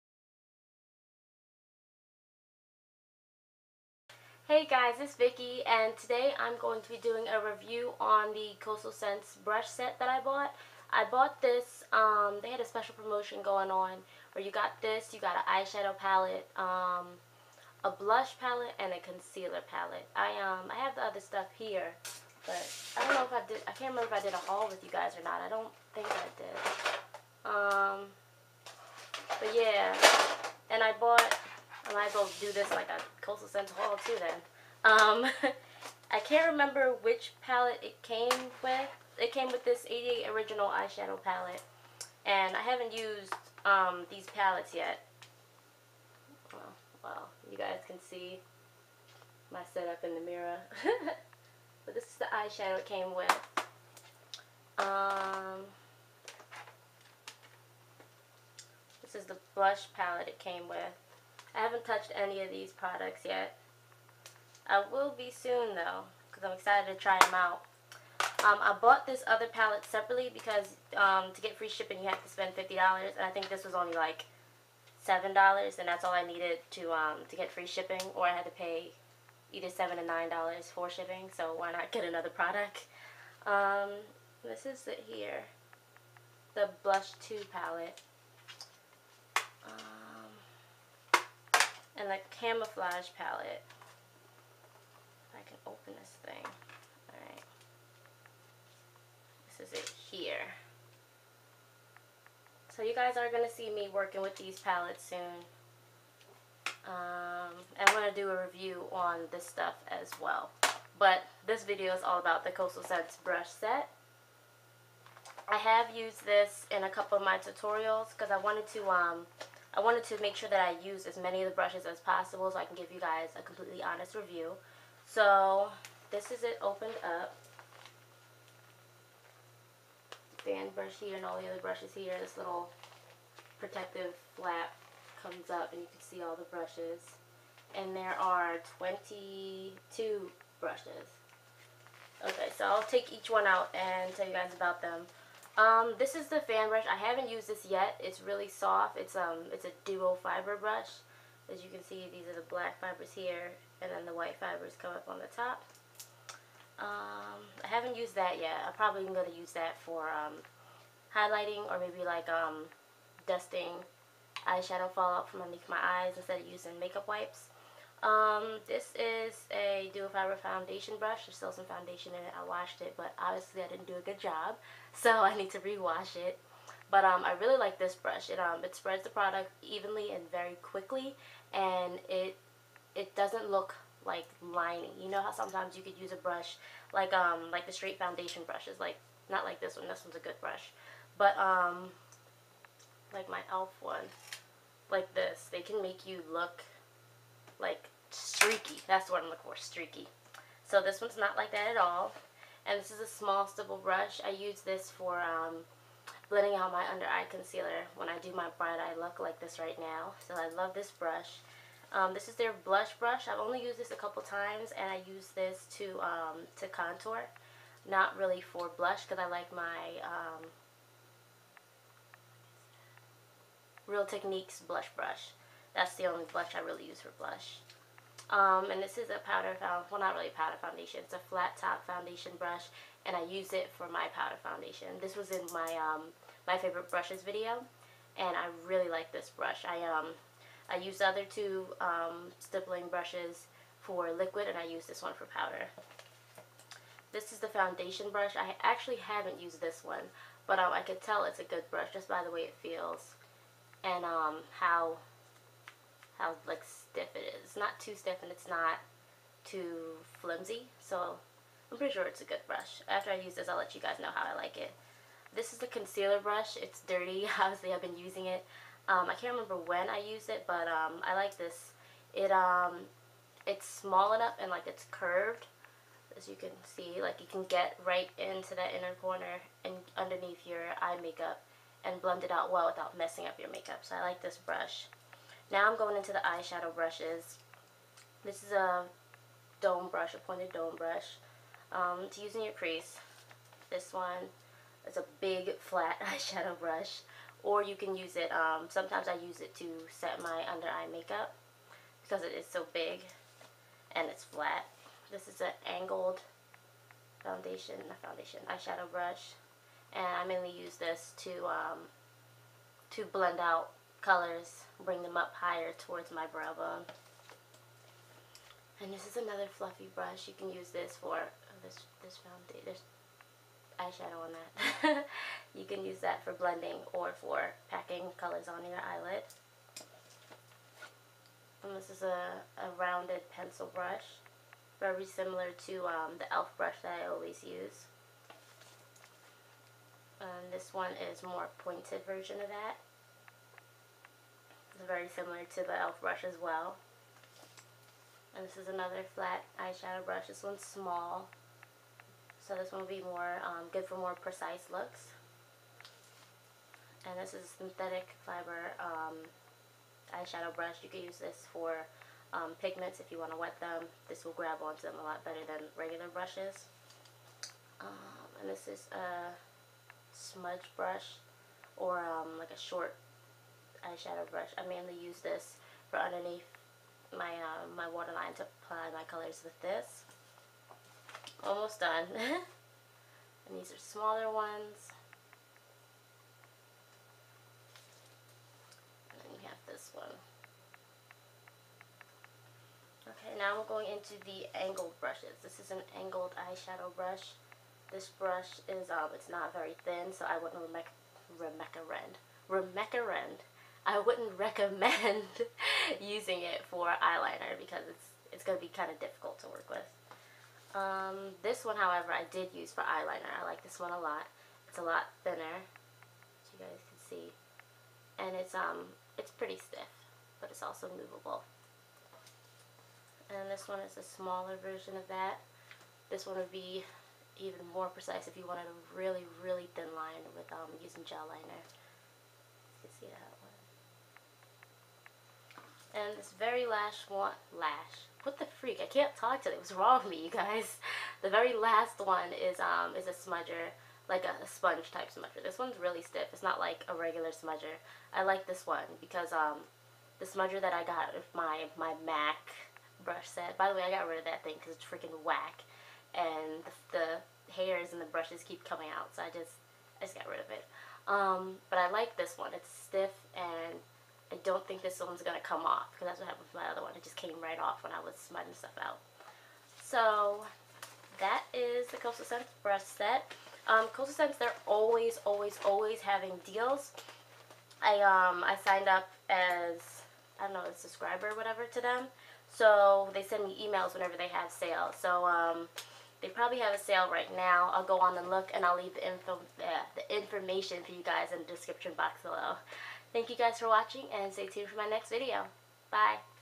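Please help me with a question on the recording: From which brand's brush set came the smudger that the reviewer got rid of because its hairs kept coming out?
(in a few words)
Mac.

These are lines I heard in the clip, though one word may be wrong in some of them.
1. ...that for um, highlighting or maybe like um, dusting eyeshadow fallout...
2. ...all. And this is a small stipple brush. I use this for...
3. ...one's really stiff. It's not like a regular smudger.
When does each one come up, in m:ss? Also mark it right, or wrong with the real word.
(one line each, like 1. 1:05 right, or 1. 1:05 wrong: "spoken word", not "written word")
1. 2:39 right
2. 3:21 right
3. 7:25 right.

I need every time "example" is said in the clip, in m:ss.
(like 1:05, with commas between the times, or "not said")
not said.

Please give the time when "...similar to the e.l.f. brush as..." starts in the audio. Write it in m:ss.
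5:45.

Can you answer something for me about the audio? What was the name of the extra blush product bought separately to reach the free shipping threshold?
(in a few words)
Blush Too palette.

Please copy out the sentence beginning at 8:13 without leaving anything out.
Thank you guys for watching and stay tuned for my next video.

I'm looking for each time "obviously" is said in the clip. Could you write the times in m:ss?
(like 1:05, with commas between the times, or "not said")
2:53, 4:27.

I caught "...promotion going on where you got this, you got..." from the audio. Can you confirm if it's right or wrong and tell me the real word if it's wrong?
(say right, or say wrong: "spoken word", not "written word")
right.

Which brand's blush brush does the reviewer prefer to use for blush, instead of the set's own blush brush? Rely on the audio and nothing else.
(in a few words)
Real Techniques.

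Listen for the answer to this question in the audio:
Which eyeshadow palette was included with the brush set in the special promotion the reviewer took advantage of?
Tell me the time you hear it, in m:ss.
0:39.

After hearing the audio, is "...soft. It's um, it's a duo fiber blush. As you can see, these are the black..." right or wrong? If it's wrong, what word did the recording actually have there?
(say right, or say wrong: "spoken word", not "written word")
wrong: "brush", not "blush".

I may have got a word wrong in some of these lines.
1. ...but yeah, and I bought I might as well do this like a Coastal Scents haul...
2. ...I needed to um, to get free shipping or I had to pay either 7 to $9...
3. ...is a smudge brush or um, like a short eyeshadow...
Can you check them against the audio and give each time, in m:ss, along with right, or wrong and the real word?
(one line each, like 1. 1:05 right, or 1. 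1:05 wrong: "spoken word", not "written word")
1. 0:29 right
2. 1:16 right
3. 6:08 right.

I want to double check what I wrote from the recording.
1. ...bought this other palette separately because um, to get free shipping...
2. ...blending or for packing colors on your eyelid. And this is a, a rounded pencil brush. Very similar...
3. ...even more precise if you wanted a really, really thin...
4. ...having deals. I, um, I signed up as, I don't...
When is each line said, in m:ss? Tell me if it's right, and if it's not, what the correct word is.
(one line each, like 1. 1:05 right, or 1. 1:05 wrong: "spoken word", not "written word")
1. 1:08 right
2. 5:26 right
3. 7:07 right
4. 7:55 right.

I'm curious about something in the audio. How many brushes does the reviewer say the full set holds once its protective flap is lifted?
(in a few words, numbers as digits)
22.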